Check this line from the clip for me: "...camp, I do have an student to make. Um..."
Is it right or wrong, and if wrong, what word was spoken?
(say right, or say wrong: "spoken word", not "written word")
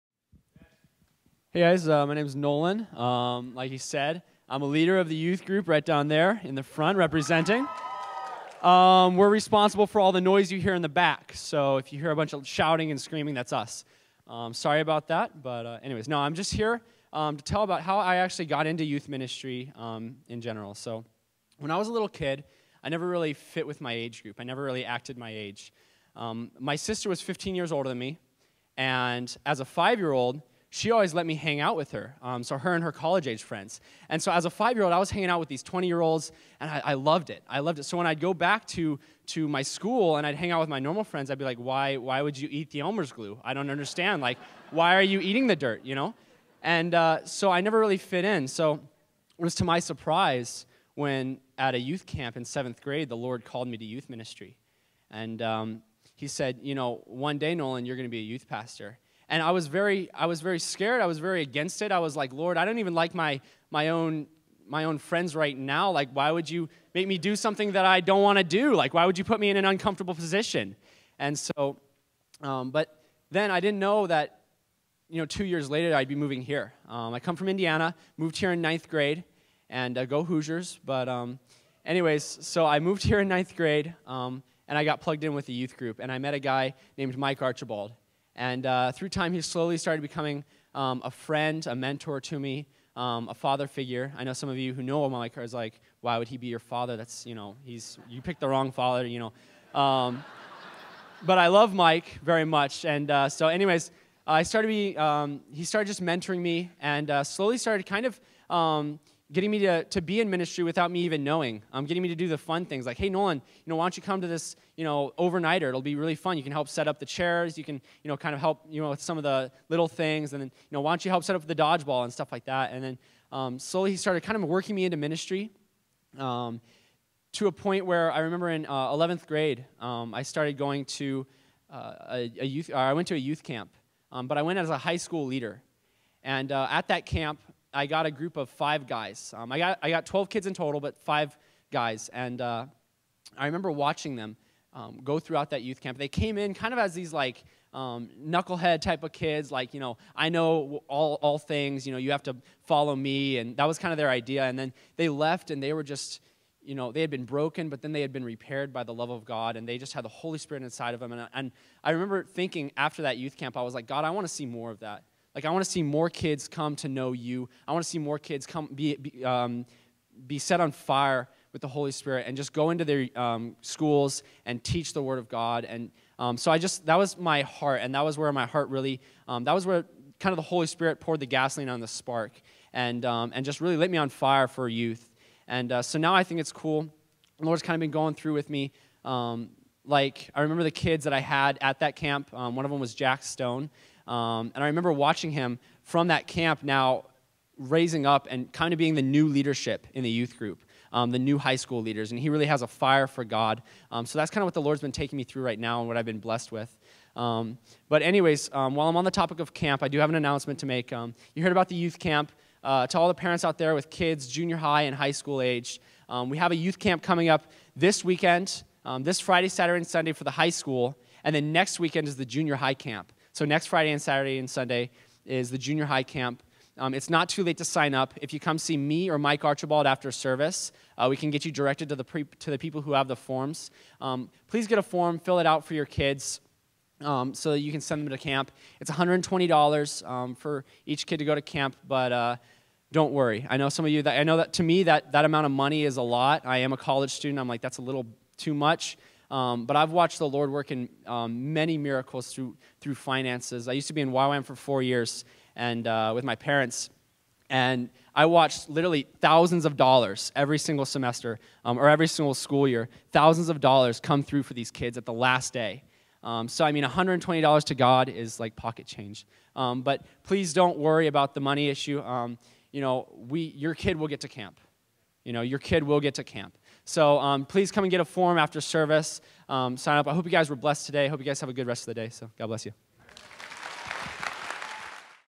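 wrong: "announcement", not "student".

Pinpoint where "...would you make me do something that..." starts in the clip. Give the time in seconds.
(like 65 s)
66 s.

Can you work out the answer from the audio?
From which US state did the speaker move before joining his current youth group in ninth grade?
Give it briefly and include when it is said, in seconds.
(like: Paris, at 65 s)
Indiana, at 77 s.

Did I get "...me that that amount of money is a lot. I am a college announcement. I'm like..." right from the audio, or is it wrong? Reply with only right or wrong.
wrong.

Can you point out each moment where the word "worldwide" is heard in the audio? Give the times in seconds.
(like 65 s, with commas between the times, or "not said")
not said.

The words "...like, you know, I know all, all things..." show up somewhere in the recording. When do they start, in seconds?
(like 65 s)
149 s.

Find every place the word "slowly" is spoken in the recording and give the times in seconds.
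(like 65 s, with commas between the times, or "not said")
89 s, 107 s, 123 s.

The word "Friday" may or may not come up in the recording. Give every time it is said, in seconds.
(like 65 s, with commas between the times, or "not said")
219 s, 223 s.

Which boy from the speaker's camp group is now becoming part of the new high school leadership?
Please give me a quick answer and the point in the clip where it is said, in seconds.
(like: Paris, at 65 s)
Jack Stone, at 192 s.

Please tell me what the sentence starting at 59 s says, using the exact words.
And I was very, I was very scared.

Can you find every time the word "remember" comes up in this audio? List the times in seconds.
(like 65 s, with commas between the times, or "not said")
128 s, 143 s, 161 s, 190 s, 194 s.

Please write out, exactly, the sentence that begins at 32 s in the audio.
Um, so her and her college age friends.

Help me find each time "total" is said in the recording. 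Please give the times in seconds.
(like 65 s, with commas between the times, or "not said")
140 s.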